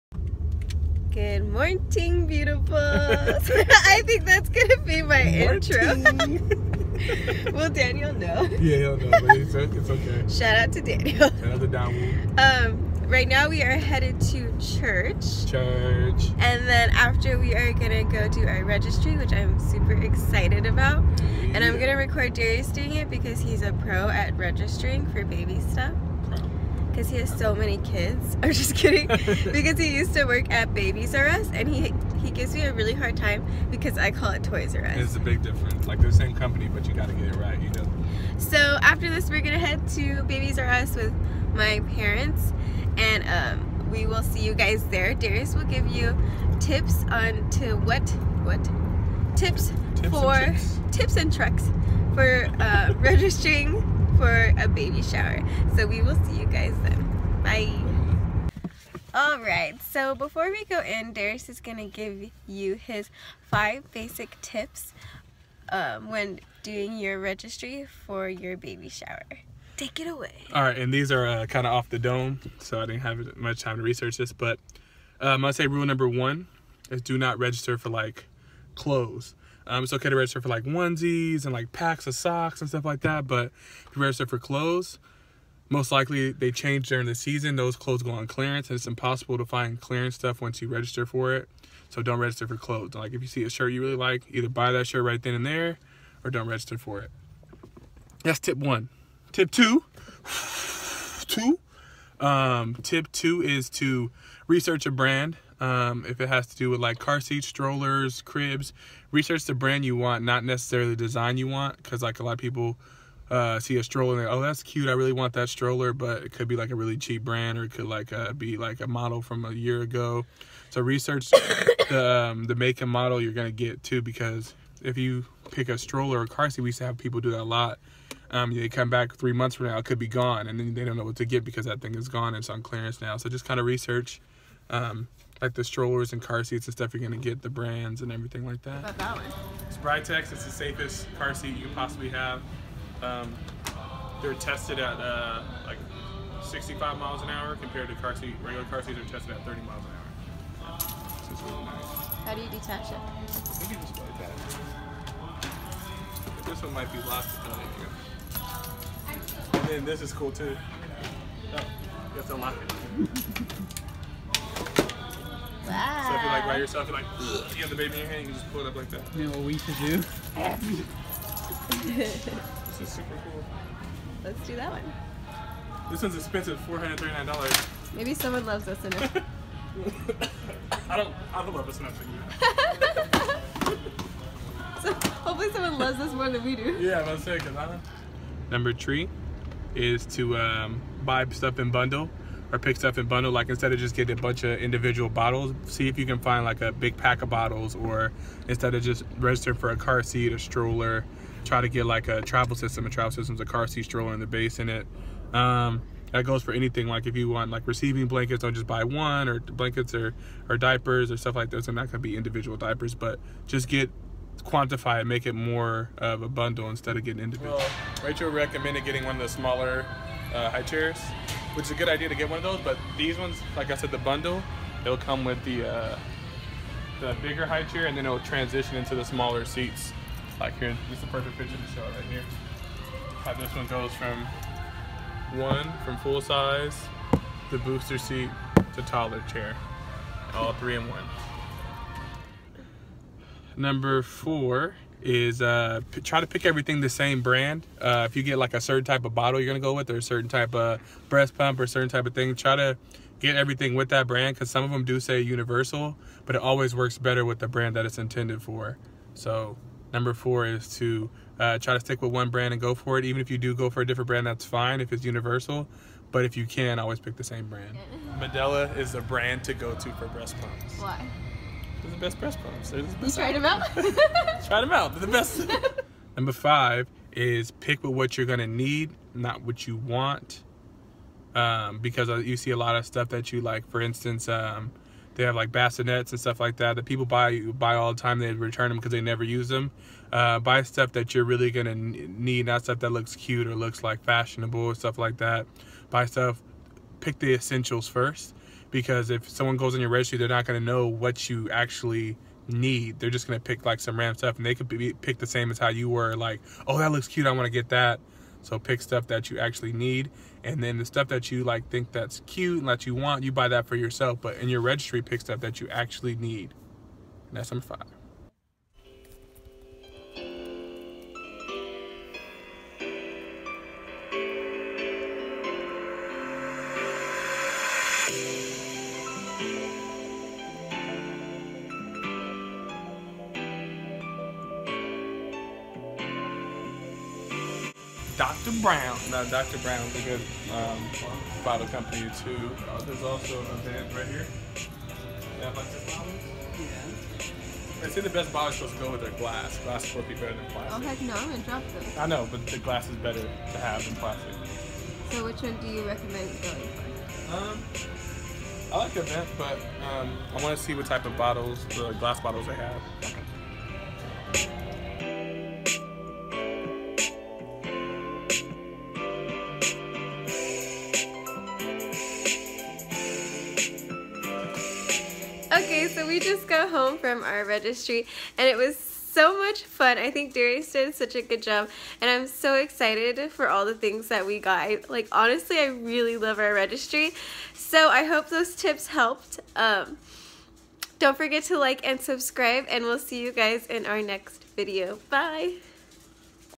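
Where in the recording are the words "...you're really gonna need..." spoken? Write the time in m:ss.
4:51.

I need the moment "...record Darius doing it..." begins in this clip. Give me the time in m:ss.
0:21.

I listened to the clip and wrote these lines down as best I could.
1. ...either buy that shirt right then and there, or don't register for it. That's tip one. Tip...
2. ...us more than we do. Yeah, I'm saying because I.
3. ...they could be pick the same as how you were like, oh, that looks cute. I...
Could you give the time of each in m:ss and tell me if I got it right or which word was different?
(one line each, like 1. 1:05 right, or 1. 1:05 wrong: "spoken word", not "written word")
1. 1:34 right
2. 3:05 right
3. 5:04 right.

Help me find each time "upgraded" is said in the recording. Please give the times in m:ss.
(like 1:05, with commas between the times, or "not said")
not said.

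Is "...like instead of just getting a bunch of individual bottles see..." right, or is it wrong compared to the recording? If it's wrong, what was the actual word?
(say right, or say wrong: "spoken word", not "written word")
right.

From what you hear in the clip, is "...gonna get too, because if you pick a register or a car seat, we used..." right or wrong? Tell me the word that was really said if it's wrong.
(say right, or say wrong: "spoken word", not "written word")
wrong: "stroller", not "register".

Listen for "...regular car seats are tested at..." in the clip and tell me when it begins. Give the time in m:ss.
2:28.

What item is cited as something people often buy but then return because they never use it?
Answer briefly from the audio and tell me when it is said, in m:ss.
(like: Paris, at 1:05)
Bassinets, at 4:45.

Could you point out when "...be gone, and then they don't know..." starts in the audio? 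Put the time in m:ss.
2:09.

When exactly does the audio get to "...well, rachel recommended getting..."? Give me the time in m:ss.
3:37.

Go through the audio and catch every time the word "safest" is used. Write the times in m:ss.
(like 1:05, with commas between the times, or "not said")
2:20.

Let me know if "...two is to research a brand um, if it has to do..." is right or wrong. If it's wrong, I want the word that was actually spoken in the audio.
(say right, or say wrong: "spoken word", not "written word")
right.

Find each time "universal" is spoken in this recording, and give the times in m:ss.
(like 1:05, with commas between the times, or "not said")
4:15, 4:25.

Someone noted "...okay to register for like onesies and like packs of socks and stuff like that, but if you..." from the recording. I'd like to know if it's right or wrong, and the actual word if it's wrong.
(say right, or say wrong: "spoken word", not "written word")
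right.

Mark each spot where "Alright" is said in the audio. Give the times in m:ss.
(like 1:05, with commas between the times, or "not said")
0:59, 1:10.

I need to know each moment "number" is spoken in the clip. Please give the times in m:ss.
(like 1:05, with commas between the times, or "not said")
1:15, 3:08, 4:03, 4:19, 4:36, 5:17.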